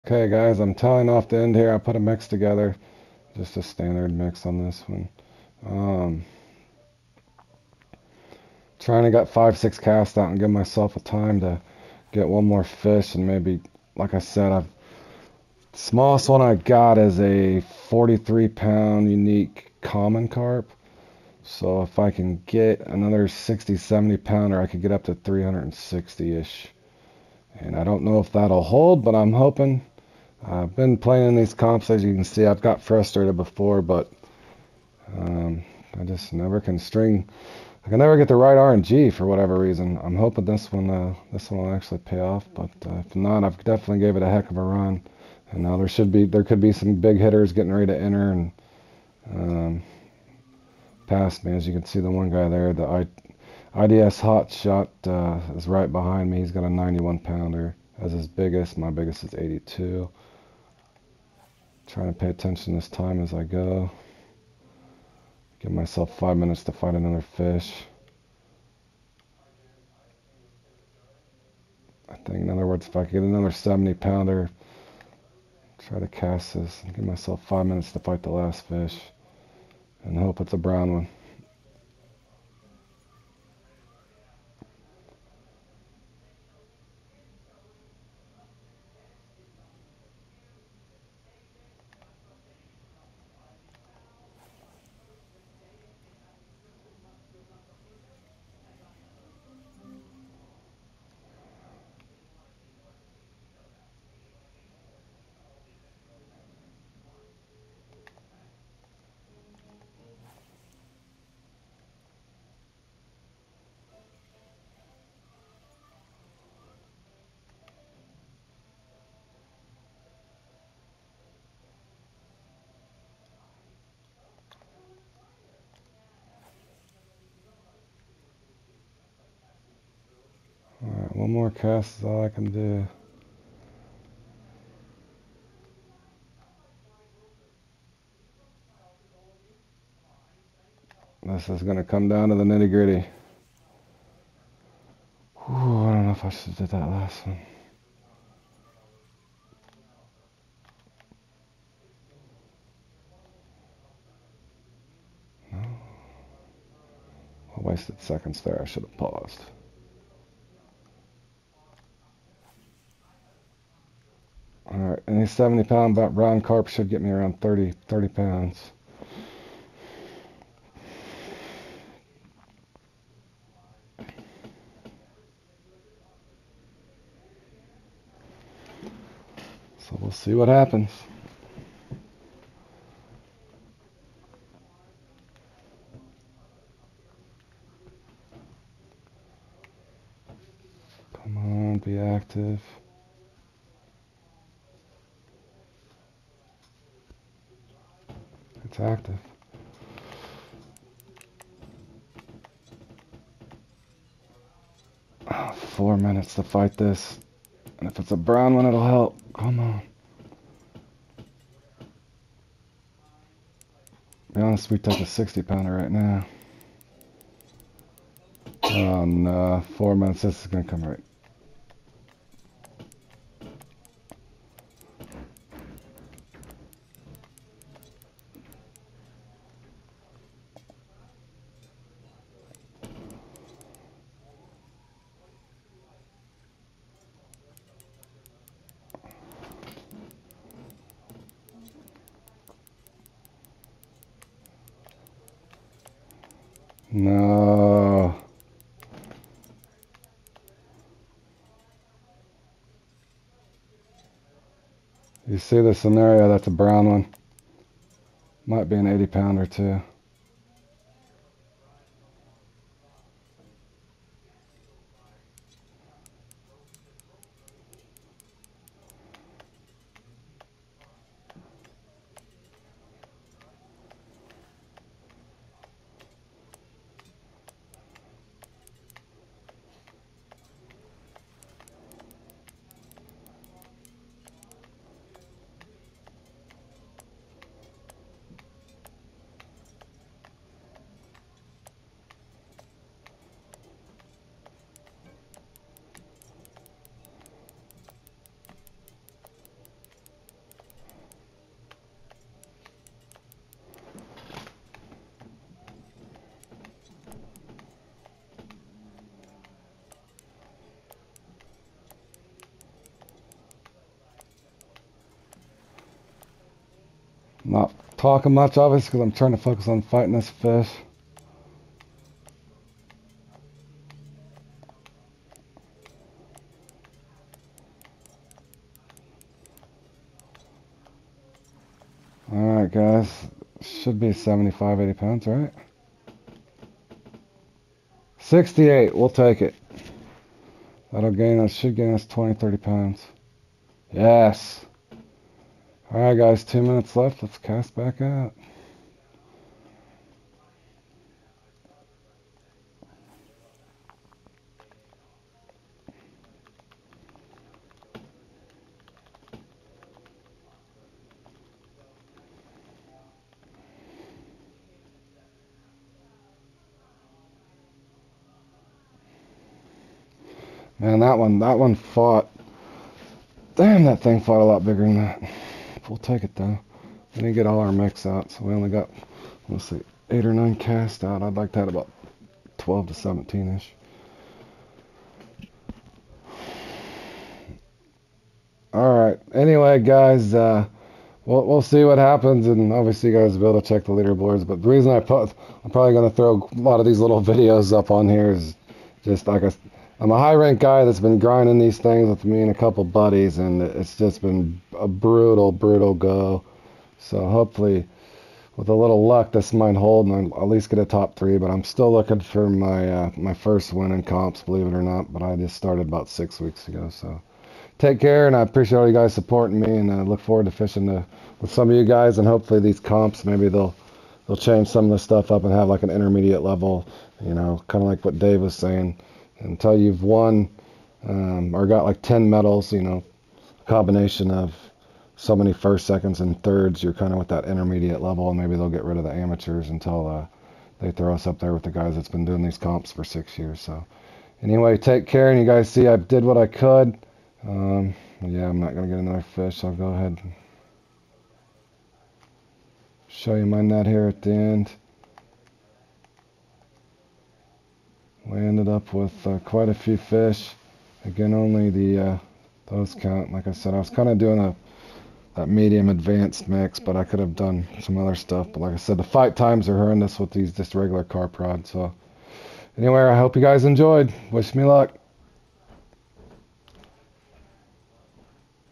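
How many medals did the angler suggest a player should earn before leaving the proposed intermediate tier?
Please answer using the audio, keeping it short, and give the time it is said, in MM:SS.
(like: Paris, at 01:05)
10, at 07:12.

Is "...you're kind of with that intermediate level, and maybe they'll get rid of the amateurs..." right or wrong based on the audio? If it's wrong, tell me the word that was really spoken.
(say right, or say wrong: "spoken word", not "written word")
right.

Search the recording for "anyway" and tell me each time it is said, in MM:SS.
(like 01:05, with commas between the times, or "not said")
06:29, 07:24, 07:52.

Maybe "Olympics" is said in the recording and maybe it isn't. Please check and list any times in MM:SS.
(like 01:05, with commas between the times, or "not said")
not said.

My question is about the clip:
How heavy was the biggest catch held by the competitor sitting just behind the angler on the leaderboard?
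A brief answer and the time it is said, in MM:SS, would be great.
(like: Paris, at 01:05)
91 pounds, at 00:56.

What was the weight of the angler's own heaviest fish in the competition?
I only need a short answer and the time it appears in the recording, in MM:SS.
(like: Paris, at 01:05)
82 pounds, at 00:59.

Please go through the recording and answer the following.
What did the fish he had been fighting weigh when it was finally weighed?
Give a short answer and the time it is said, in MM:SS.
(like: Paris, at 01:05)
68, at 05:38.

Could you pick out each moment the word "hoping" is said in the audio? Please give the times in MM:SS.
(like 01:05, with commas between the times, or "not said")
00:29, 00:40.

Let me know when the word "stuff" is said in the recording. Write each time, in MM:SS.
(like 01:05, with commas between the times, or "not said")
07:04, 07:48.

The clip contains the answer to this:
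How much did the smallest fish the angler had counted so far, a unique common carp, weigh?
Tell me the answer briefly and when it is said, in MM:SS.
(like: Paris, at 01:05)
43 pounds, at 00:17.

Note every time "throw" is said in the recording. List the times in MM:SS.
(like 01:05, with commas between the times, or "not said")
06:36, 07:20.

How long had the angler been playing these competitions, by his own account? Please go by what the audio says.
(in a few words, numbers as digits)
six weeks.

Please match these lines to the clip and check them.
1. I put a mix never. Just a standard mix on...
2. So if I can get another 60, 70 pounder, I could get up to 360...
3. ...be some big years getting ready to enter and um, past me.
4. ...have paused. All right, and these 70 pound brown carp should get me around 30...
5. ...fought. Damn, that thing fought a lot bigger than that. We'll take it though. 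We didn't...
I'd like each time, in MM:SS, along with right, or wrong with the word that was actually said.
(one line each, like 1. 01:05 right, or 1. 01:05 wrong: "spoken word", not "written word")
1. 00:01 wrong: "together", not "never"
2. 00:21 right
3. 00:46 wrong: "hitters", not "years"
4. 02:38 right
5. 06:11 right.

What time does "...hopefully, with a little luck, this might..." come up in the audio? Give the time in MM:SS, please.
06:47.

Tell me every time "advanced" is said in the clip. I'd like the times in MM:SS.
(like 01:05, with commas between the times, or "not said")
07:45.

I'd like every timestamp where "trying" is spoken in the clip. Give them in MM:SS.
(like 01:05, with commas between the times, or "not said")
00:08, 01:01, 05:19.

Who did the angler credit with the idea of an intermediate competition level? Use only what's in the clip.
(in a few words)
Dave.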